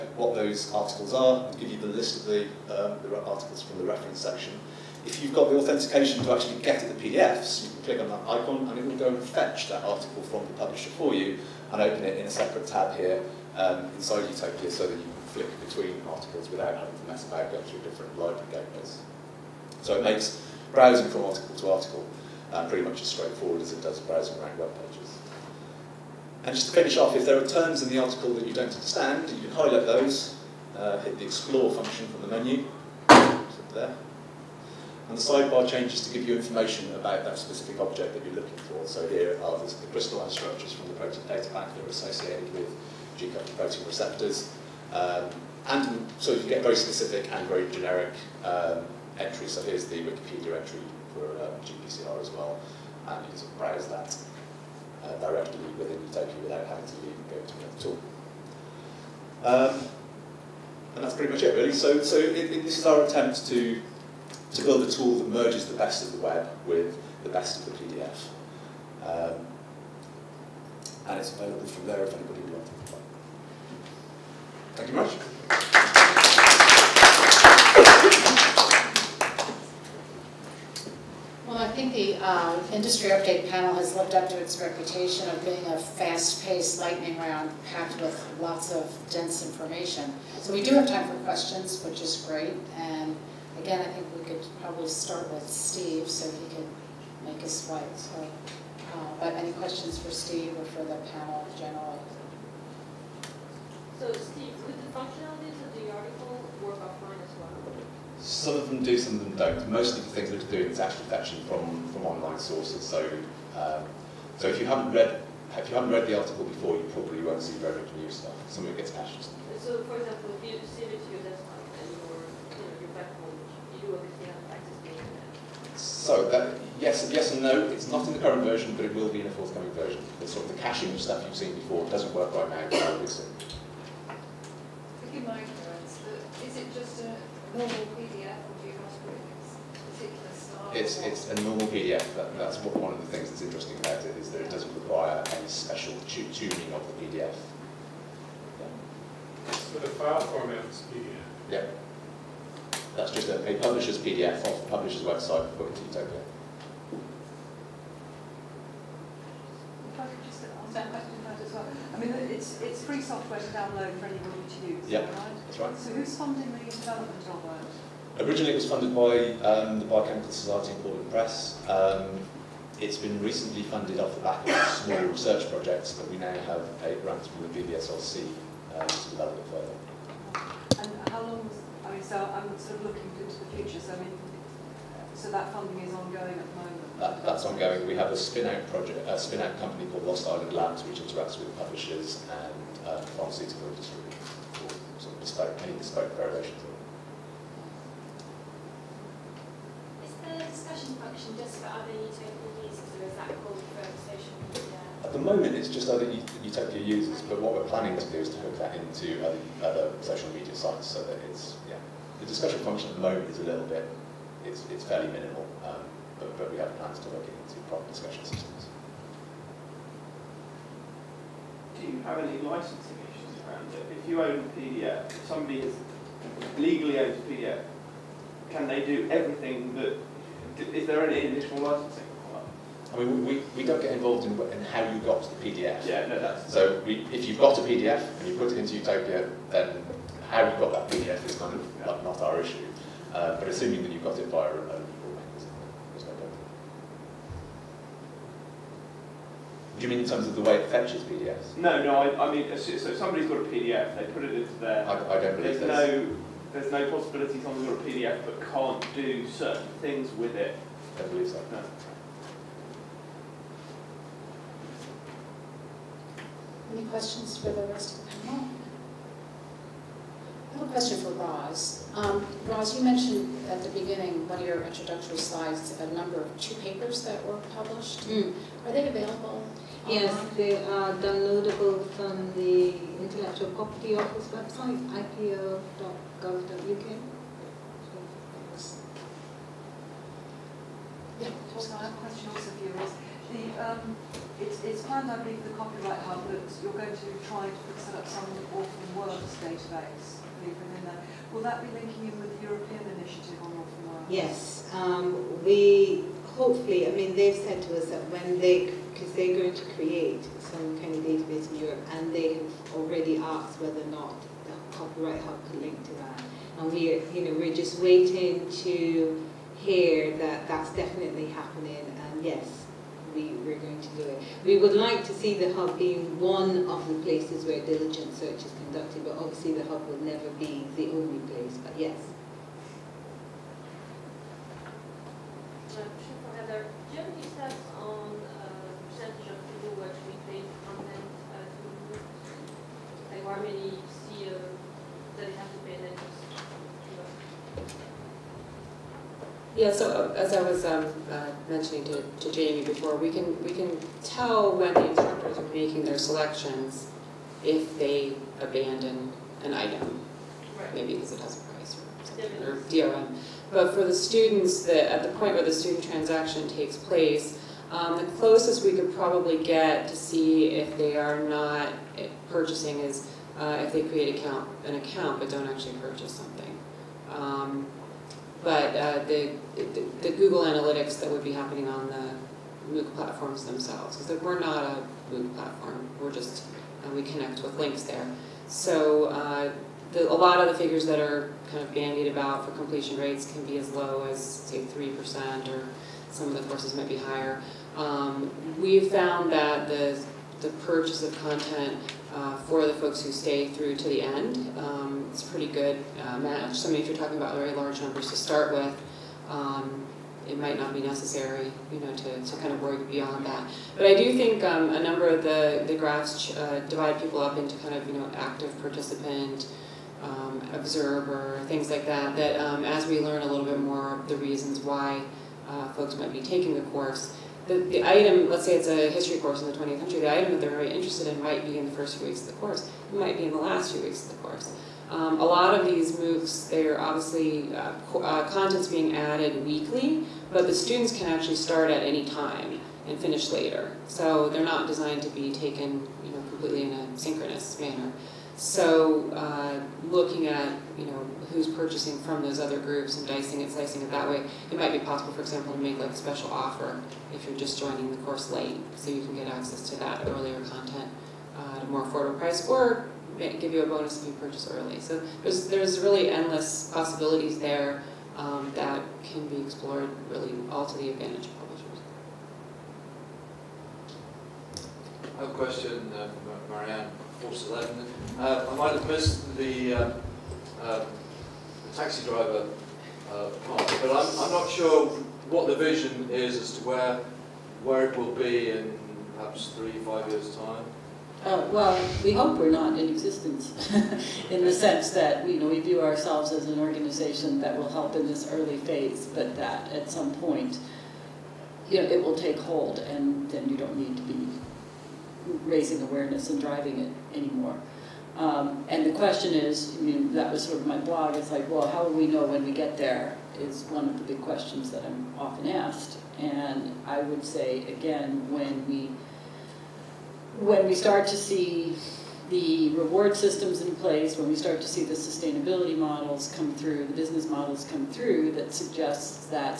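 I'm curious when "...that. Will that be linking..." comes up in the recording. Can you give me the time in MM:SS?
05:00.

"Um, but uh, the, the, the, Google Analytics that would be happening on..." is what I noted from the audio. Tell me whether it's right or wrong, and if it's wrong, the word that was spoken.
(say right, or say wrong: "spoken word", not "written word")
right.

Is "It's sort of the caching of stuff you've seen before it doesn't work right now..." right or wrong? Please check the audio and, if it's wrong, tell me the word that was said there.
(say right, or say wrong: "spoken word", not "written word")
right.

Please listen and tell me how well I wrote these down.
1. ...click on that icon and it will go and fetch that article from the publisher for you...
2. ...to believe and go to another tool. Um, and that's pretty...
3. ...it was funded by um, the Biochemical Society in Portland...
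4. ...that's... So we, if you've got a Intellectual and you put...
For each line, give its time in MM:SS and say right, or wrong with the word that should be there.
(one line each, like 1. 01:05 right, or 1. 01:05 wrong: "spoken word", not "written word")
1. 00:07 right
2. 00:56 wrong: "leave", not "believe"
3. 02:48 right
4. 03:56 wrong: "PDF", not "Intellectual".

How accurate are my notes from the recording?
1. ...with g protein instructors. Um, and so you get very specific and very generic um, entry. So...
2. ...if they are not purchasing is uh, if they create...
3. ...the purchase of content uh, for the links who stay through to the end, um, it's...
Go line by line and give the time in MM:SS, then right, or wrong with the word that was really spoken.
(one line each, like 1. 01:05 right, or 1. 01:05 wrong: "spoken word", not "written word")
1. 00:42 wrong: "receptors", not "instructors"
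2. 06:10 right
3. 06:40 wrong: "folks", not "links".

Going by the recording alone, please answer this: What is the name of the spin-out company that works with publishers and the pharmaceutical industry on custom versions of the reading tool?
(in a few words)
Lost Island Labs.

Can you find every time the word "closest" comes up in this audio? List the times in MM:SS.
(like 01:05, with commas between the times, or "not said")
06:08.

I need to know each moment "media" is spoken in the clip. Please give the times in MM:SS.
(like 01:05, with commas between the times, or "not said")
03:24, 03:30.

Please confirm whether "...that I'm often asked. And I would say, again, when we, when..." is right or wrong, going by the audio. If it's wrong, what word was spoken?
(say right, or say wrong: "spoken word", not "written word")
right.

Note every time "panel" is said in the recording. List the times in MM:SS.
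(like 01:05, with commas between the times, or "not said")
01:23, 01:41, 04:28.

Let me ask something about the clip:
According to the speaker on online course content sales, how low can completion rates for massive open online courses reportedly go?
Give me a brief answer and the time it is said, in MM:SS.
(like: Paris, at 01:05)
3%, at 06:34.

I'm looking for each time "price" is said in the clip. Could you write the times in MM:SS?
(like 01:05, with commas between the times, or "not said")
06:01, 07:42.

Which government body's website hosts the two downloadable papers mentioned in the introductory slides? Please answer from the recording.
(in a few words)
Intellectual Property Office.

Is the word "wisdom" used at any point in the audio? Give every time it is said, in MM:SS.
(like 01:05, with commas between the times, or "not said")
not said.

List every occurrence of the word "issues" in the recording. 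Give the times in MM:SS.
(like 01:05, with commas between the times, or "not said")
03:43, 04:02.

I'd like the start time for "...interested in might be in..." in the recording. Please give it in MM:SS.
07:10.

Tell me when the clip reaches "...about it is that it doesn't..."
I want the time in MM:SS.
02:23.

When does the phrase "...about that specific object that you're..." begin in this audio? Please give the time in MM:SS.
00:36.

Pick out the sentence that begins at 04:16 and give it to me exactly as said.
no there's no possibility someone's got a PDF but can't do certain things with it.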